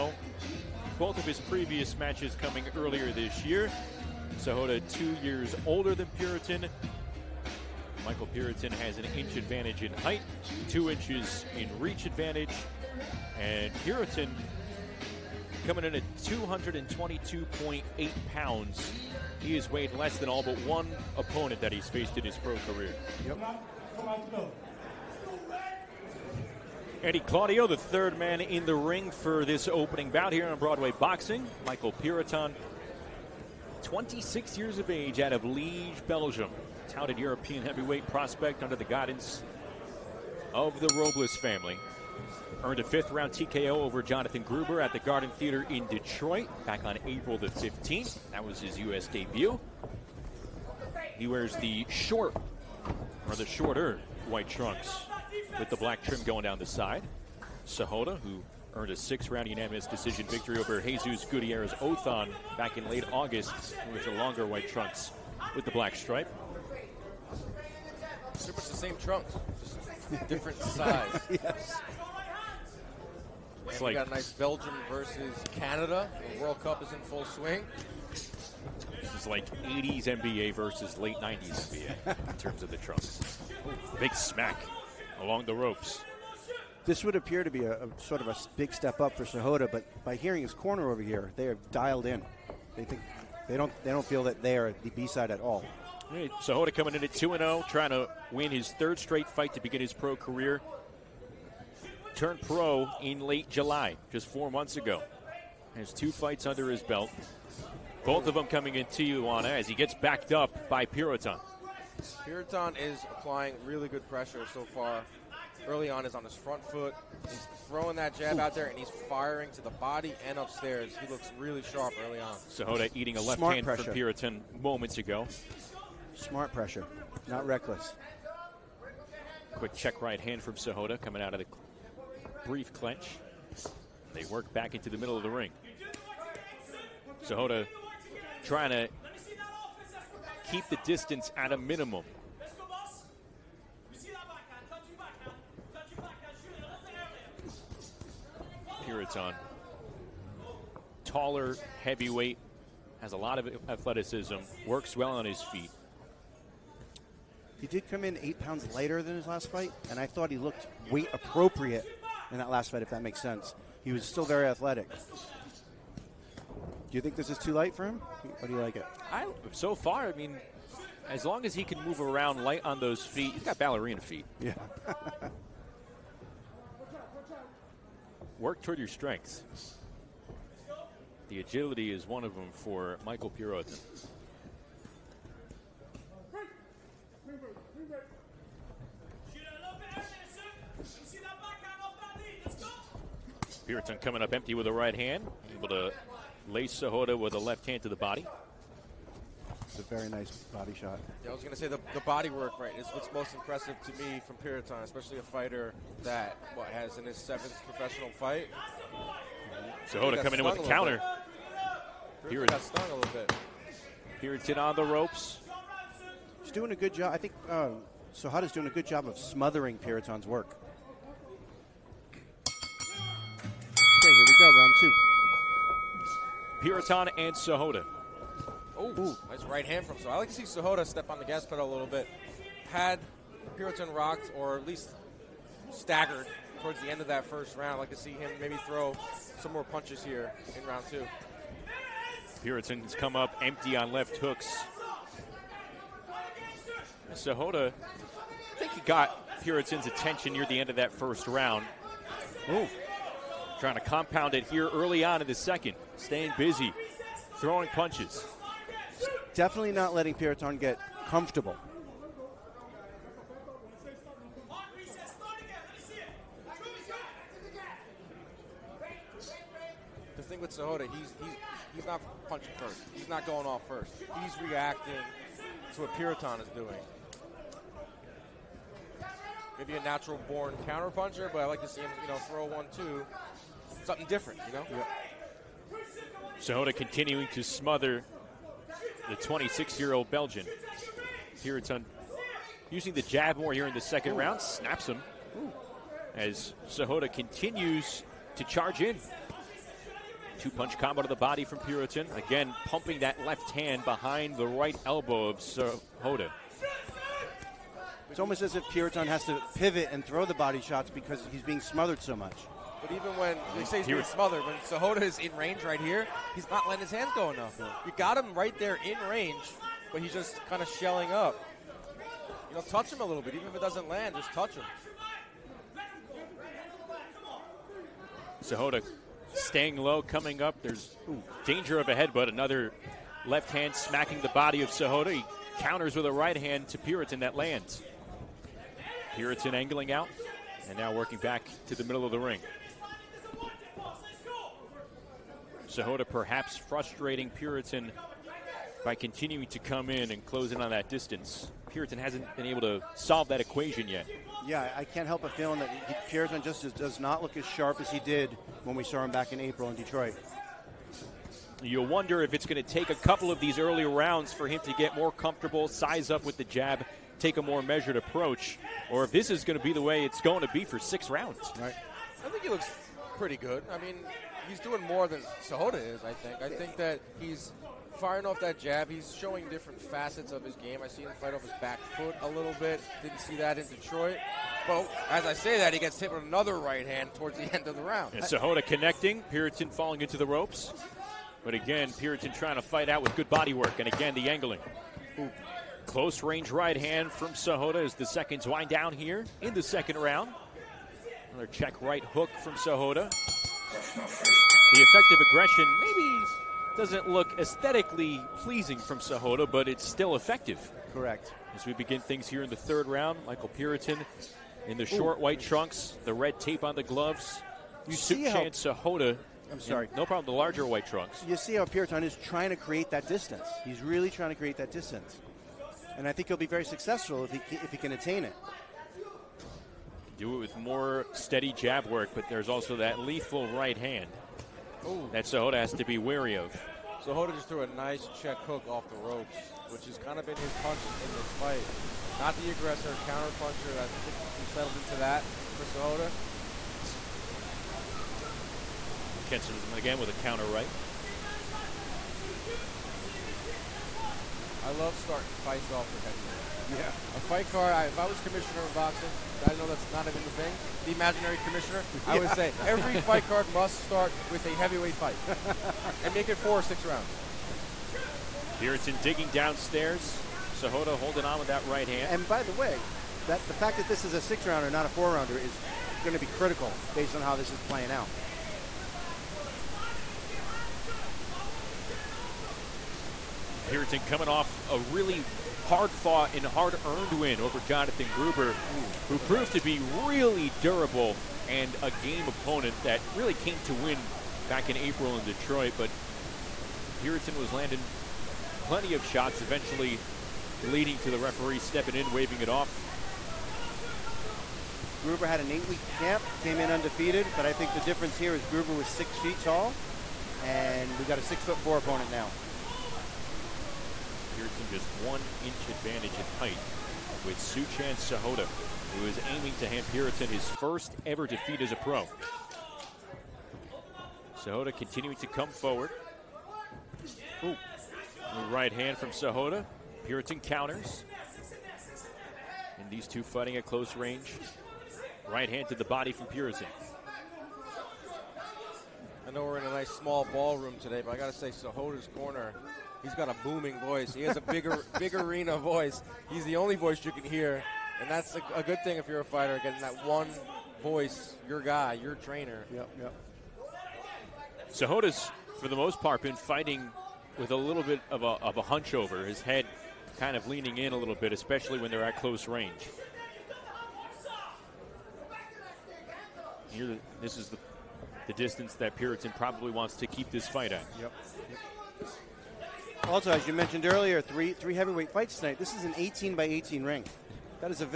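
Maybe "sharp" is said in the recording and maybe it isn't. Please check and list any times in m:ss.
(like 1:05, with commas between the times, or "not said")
2:01, 5:57.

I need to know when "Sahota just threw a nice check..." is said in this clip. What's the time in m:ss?
7:17.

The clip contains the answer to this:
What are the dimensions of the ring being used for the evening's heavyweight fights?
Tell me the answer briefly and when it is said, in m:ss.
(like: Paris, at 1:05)
18 by 18, at 9:35.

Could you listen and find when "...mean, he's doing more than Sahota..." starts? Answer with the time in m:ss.
6:13.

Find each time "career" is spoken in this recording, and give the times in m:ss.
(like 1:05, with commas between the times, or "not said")
0:22, 1:40.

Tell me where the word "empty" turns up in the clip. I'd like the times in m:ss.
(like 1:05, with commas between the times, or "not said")
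3:14, 4:03.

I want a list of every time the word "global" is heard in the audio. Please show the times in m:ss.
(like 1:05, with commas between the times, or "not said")
not said.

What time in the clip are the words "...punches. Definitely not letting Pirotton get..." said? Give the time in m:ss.
4:17.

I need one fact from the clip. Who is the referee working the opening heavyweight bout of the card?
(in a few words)
Eddie Claudio.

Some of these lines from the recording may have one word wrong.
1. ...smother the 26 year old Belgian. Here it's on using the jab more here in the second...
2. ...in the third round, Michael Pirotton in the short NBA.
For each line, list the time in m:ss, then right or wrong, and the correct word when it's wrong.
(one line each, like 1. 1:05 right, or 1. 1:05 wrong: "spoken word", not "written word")
1. 4:47 right
2. 6:52 wrong: "Ooh", not "NBA".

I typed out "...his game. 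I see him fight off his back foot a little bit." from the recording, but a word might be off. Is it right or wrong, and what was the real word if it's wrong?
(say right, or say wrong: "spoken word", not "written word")
right.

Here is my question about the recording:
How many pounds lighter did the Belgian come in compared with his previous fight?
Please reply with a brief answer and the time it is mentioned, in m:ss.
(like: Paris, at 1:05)
8, at 2:38.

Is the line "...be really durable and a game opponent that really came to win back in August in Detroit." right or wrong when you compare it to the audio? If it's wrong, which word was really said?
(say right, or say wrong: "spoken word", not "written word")
wrong: "April", not "August".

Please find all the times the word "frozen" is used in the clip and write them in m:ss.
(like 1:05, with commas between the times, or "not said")
not said.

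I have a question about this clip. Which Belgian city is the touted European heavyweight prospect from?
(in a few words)
Liege.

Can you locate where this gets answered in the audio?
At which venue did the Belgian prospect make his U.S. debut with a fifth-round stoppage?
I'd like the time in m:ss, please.
0:44.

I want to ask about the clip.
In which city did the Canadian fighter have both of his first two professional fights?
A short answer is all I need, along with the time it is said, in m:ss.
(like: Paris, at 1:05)
Tijuana, at 1:48.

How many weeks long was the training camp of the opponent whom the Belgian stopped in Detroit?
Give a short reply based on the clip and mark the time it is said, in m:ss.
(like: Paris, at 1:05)
8, at 8:25.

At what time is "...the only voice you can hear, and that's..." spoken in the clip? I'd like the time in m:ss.
9:06.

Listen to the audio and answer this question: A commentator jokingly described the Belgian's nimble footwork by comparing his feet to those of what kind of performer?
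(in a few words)
ballerina.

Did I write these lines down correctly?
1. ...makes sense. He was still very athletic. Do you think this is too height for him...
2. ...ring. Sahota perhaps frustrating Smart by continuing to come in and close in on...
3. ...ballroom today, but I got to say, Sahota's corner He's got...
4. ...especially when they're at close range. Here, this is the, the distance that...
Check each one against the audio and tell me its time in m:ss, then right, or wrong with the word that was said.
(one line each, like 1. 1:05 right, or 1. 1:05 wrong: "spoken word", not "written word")
1. 2:43 wrong: "light", not "height"
2. 5:42 wrong: "Pirotton", not "Smart"
3. 9:00 right
4. 9:21 right.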